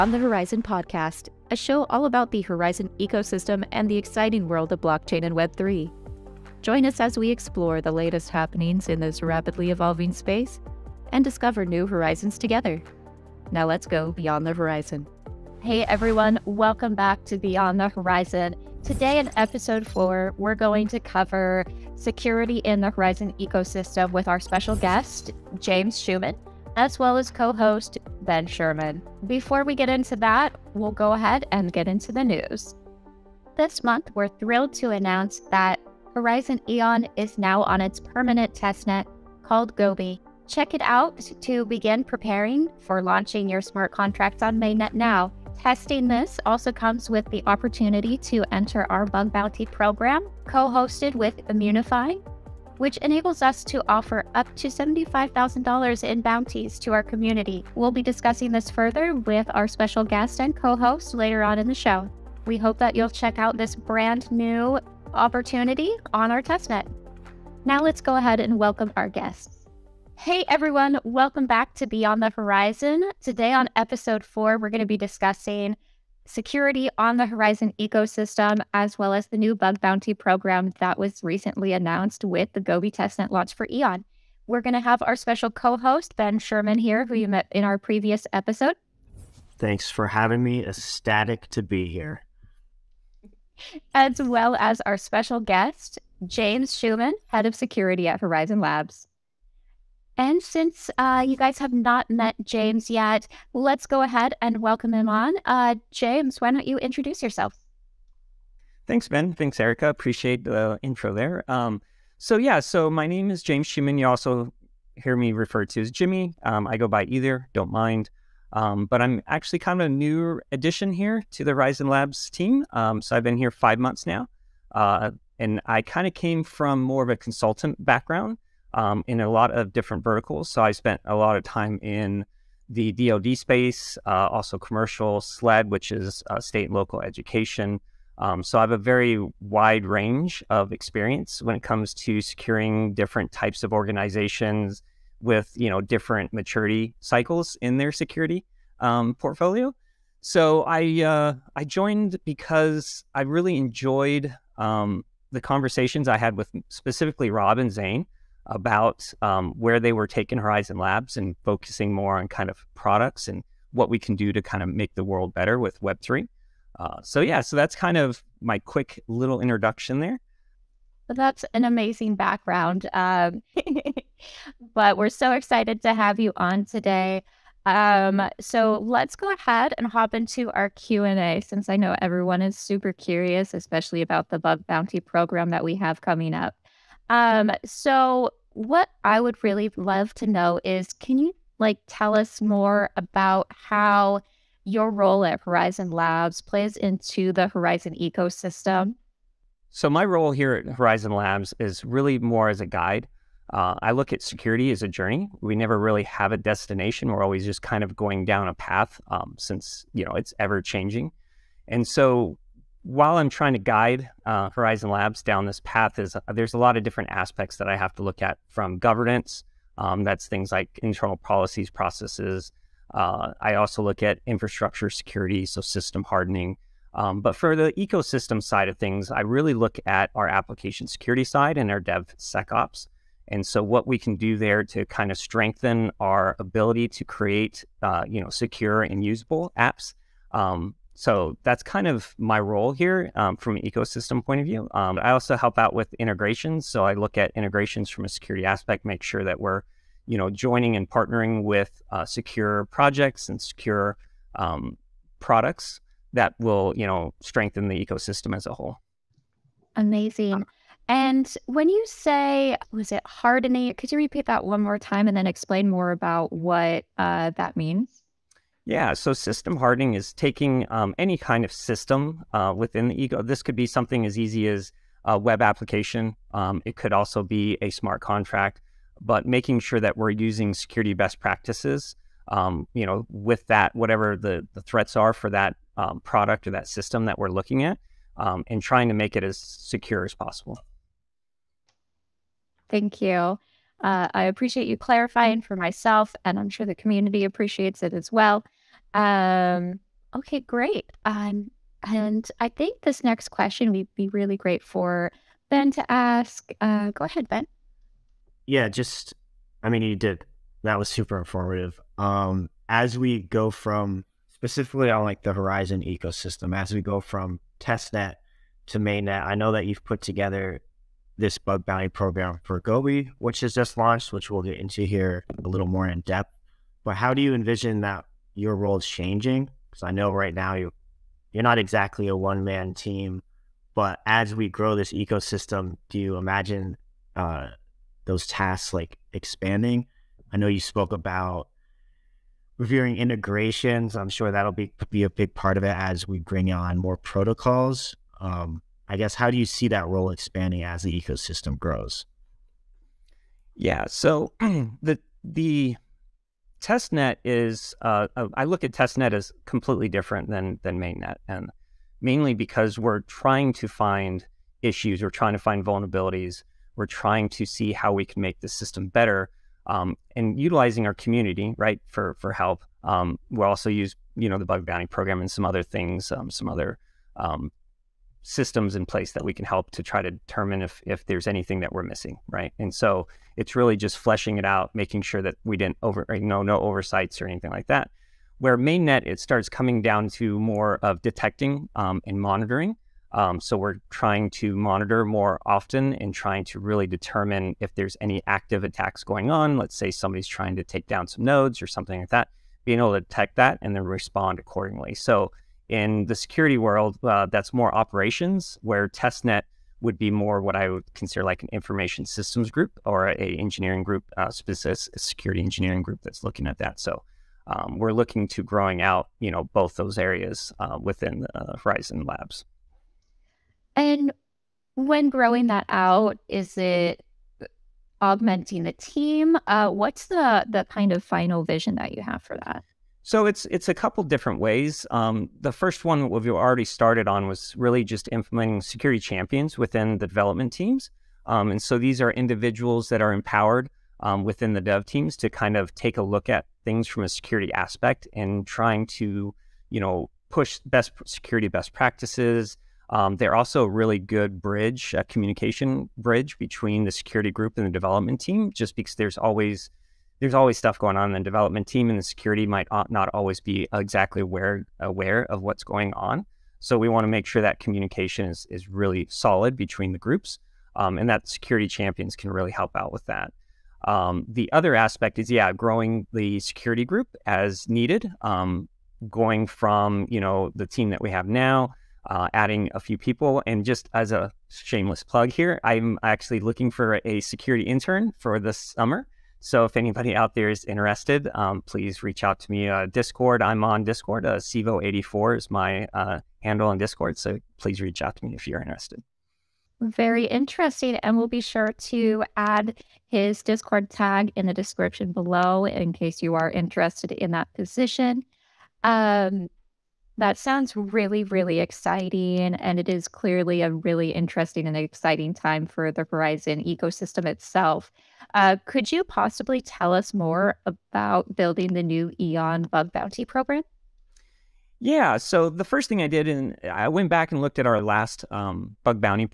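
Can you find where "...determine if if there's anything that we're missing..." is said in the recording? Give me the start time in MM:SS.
06:20.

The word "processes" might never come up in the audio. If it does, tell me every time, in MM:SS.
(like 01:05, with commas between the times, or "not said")
03:41.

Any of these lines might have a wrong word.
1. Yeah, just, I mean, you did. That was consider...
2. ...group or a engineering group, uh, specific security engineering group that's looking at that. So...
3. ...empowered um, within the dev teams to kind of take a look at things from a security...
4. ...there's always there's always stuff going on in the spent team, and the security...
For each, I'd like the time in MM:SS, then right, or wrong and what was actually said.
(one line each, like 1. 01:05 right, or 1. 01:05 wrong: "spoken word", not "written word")
1. 05:08 wrong: "super", not "consider"
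2. 06:52 right
3. 07:23 right
4. 07:38 wrong: "development", not "spent".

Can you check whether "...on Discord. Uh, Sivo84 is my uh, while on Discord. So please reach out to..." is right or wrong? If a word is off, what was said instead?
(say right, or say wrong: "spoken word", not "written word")
wrong: "handle", not "while".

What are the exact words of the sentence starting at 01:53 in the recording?
You also hear me referred to as Jimmy.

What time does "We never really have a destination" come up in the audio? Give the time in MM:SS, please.
03:25.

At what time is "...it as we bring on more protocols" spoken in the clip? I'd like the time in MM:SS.
05:45.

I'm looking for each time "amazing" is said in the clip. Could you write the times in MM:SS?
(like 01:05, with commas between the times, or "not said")
02:51, 04:19.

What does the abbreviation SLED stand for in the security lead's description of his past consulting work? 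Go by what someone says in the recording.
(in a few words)
state and local education.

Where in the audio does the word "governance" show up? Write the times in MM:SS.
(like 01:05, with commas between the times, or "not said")
03:38.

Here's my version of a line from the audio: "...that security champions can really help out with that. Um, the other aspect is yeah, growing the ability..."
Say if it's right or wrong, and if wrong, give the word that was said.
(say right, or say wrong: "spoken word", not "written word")
wrong: "security", not "ability".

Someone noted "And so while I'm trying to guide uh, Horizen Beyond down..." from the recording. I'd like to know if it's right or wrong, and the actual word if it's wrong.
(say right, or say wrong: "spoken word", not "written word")
wrong: "Labs", not "Beyond".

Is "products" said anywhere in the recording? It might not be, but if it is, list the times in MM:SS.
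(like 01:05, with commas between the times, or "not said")
02:42, 04:15, 04:46.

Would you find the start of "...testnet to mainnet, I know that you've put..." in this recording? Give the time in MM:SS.
05:17.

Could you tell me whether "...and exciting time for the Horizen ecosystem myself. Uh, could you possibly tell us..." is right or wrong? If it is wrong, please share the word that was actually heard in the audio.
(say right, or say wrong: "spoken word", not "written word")
wrong: "itself", not "myself".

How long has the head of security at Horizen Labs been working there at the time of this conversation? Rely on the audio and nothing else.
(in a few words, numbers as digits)
5 months.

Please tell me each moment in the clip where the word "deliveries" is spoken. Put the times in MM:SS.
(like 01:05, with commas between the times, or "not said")
not said.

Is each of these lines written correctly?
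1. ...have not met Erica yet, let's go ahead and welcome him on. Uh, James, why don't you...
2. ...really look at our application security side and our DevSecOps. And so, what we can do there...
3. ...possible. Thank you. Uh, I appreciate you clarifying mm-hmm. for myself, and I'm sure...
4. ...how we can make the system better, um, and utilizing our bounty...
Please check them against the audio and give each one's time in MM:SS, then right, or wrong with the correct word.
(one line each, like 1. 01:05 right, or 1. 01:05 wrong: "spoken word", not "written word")
1. 01:41 wrong: "James", not "Erica"
2. 03:49 right
3. 04:50 right
4. 06:07 wrong: "community", not "bounty".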